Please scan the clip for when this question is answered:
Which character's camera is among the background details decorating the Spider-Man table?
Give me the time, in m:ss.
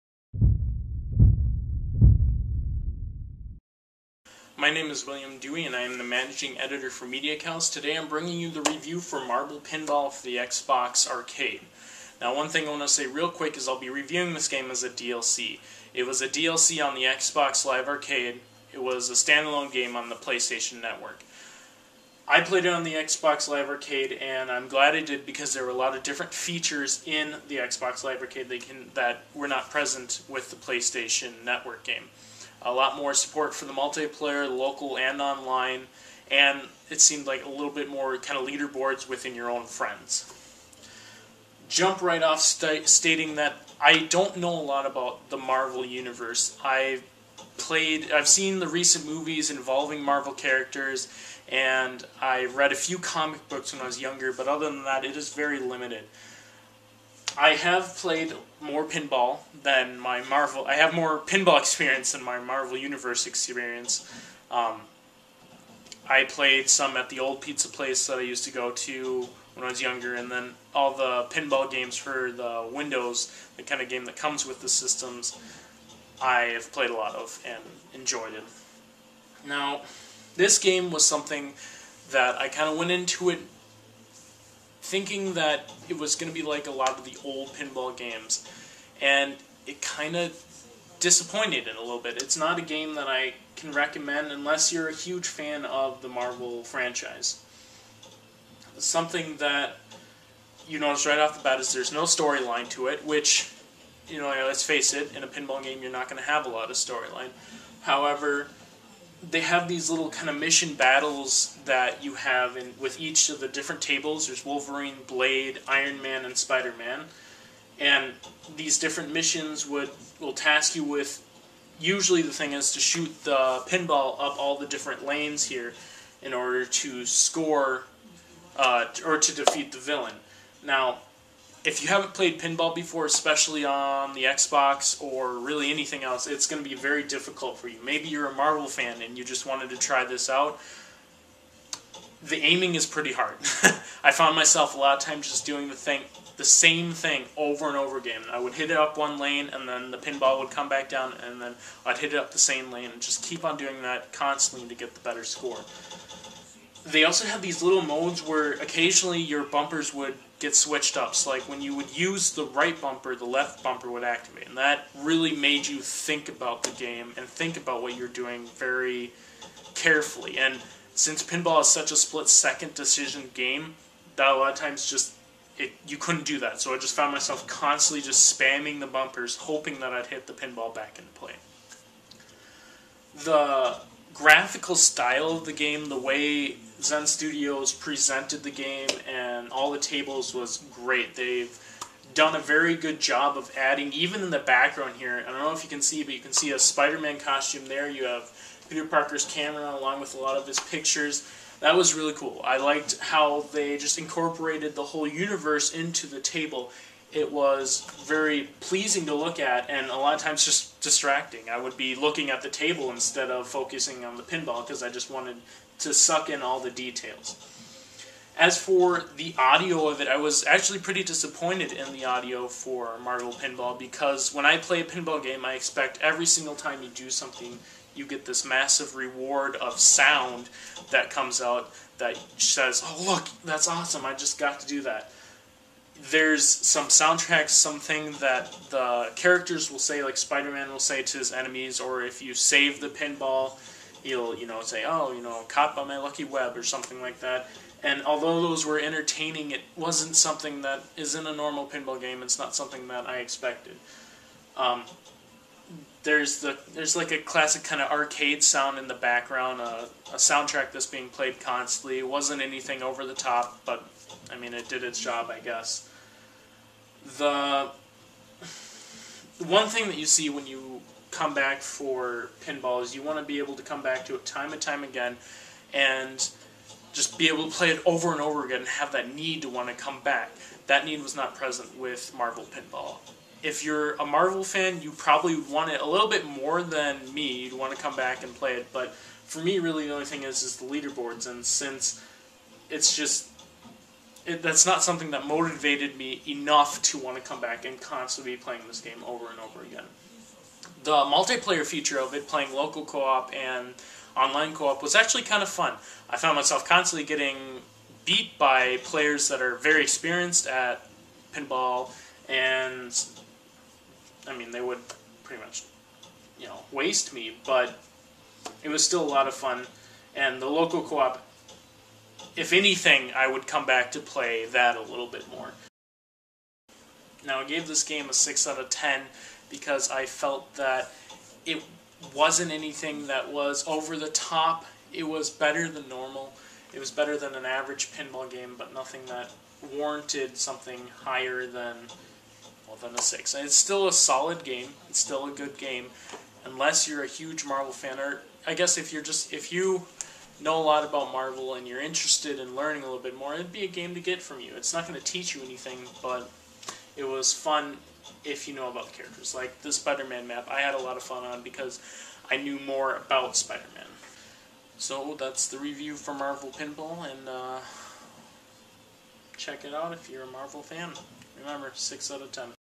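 3:18.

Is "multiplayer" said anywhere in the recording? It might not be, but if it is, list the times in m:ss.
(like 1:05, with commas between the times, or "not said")
0:33, 5:00.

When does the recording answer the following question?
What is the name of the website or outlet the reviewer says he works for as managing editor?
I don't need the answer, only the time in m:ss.
0:07.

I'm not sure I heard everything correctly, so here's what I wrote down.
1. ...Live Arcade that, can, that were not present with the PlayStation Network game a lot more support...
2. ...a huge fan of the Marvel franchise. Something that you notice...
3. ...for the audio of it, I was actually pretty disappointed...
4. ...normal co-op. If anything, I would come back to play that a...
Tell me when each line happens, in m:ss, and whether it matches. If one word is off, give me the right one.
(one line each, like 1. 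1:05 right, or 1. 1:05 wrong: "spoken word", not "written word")
1. 0:28 right
2. 1:34 right
3. 3:38 right
4. 5:20 wrong: "local", not "normal".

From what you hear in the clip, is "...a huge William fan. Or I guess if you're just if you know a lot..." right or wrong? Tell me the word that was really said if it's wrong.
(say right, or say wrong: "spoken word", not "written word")
wrong: "Marvel", not "William".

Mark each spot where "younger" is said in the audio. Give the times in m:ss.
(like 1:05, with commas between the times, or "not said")
0:53, 1:09.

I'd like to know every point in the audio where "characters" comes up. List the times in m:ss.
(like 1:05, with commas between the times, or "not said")
0:50, 3:59, 5:58.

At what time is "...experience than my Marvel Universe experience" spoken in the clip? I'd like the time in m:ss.
1:01.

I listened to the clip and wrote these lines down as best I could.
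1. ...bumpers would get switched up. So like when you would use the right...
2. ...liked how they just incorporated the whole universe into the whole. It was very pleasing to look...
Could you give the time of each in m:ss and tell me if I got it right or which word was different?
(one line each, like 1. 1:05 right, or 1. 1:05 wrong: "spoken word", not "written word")
1. 2:39 right
2. 3:22 wrong: "table", not "whole".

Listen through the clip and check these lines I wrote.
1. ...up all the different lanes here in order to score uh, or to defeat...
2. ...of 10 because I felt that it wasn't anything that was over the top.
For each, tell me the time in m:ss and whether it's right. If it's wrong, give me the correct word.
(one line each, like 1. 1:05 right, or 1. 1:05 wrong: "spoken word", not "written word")
1. 2:04 right
2. 5:28 right.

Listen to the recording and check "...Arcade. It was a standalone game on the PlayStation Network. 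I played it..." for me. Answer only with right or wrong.
right.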